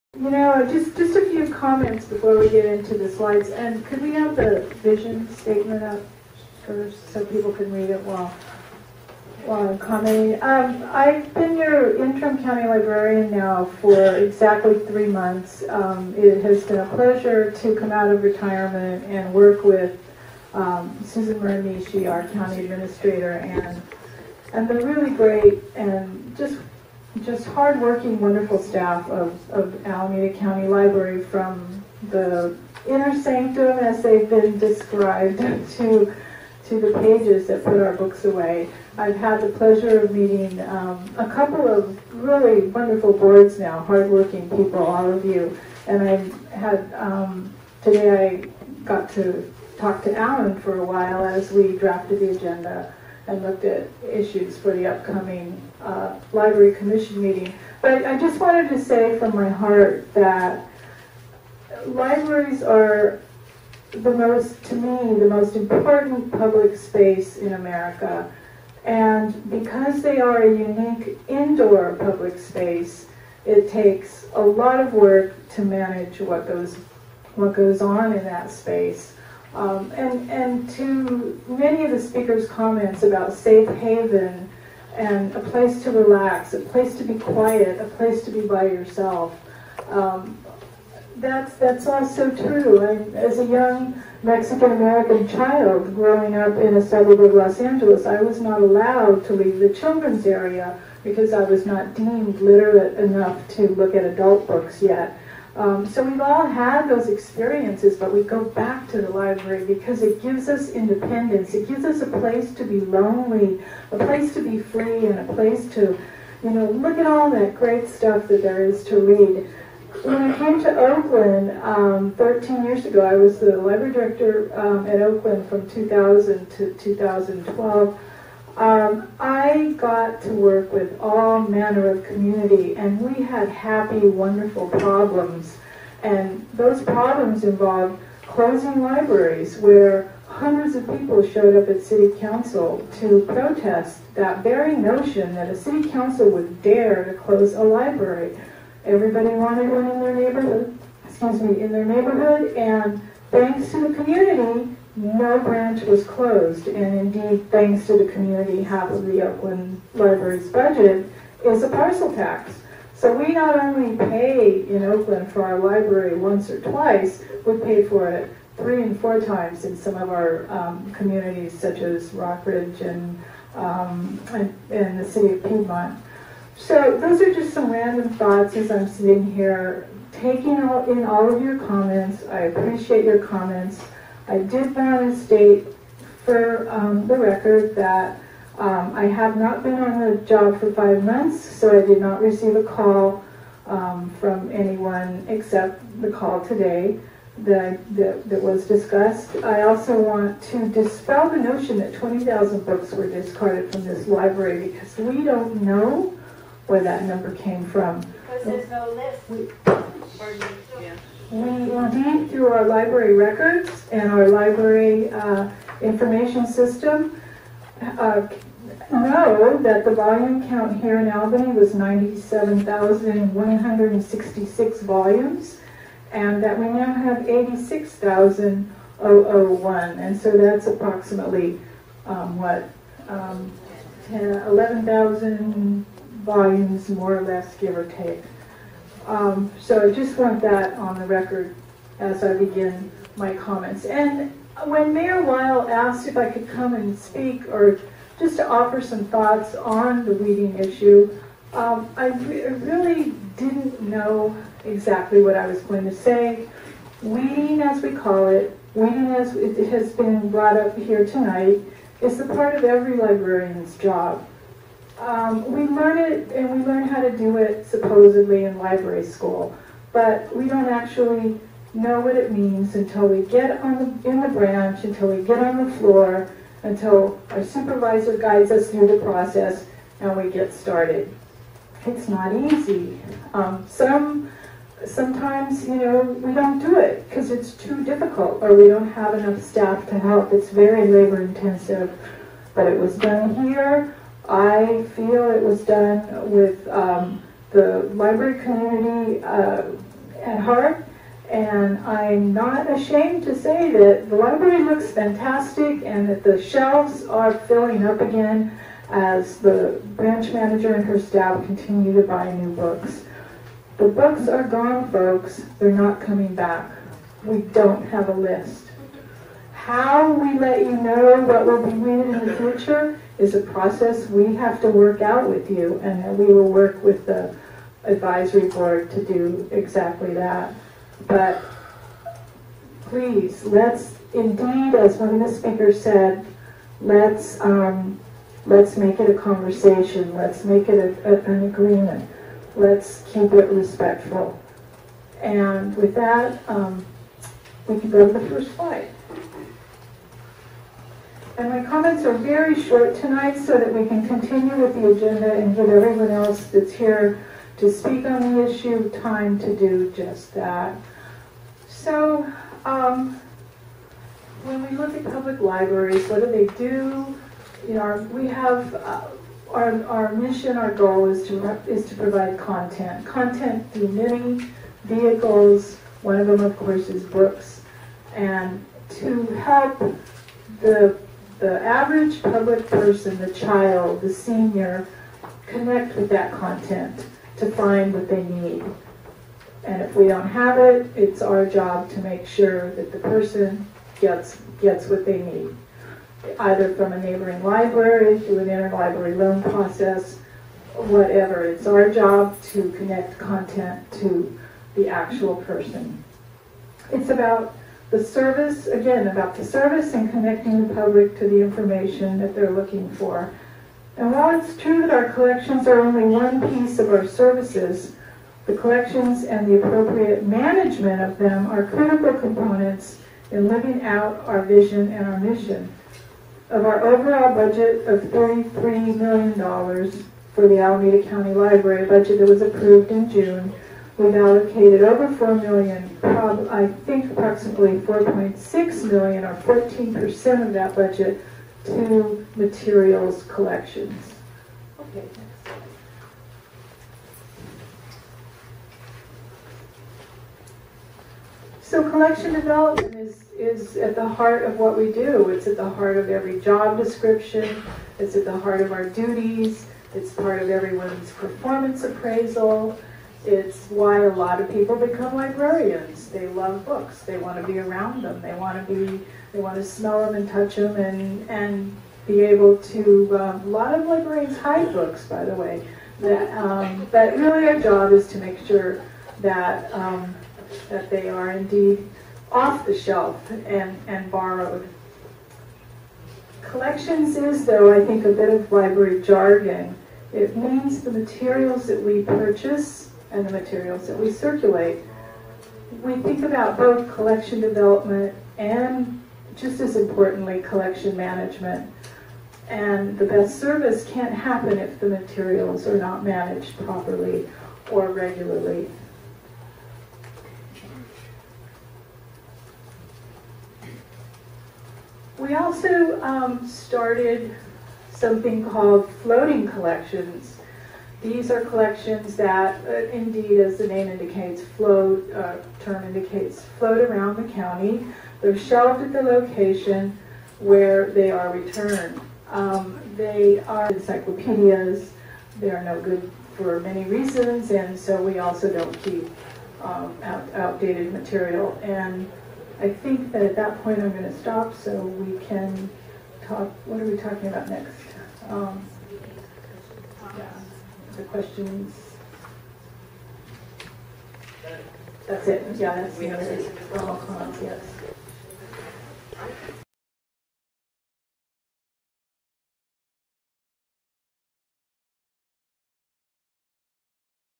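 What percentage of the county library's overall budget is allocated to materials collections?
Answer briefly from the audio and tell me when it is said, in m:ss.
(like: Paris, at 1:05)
14%, at 7:19.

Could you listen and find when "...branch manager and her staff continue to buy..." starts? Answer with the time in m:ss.
5:09.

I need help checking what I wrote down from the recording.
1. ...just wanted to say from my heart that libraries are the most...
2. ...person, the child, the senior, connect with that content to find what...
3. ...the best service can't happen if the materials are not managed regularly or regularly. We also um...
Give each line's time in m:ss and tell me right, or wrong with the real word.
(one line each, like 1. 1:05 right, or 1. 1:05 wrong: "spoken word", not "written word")
1. 0:58 right
2. 6:22 right
3. 8:22 wrong: "properly", not "regularly".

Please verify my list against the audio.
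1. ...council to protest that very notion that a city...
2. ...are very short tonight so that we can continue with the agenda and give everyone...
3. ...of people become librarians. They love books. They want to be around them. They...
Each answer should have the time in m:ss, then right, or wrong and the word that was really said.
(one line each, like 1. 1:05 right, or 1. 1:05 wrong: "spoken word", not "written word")
1. 2:22 right
2. 5:52 right
3. 7:44 right.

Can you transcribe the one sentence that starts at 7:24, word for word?
Okay, So collection development is, is at the heart of what we do.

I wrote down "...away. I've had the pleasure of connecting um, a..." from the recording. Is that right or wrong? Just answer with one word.
wrong.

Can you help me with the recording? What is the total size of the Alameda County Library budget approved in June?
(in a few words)
$33 million.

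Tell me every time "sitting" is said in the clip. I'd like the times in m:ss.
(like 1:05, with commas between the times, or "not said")
2:58.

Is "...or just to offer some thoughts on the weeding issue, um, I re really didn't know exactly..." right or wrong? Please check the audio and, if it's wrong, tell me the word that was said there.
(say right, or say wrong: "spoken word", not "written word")
right.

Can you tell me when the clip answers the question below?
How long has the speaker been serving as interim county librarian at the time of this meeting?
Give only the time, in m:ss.
0:14.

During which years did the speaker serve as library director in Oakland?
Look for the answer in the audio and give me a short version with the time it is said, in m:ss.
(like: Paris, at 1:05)
2000 to 2012, at 2:05.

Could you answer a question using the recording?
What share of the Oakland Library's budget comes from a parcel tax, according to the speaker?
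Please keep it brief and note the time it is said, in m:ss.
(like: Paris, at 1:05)
Half, at 2:38.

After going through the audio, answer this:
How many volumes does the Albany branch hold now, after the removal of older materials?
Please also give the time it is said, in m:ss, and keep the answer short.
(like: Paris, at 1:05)
86,001, at 3:47.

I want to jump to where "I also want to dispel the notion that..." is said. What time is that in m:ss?
3:19.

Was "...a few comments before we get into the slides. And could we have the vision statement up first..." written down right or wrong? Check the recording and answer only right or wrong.
right.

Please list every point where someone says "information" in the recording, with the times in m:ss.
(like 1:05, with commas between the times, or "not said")
3:35, 6:51.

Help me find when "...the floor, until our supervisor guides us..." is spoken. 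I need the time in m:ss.
4:35.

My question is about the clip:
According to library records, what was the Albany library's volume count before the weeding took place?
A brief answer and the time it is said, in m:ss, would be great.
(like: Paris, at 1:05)
97,166, at 3:41.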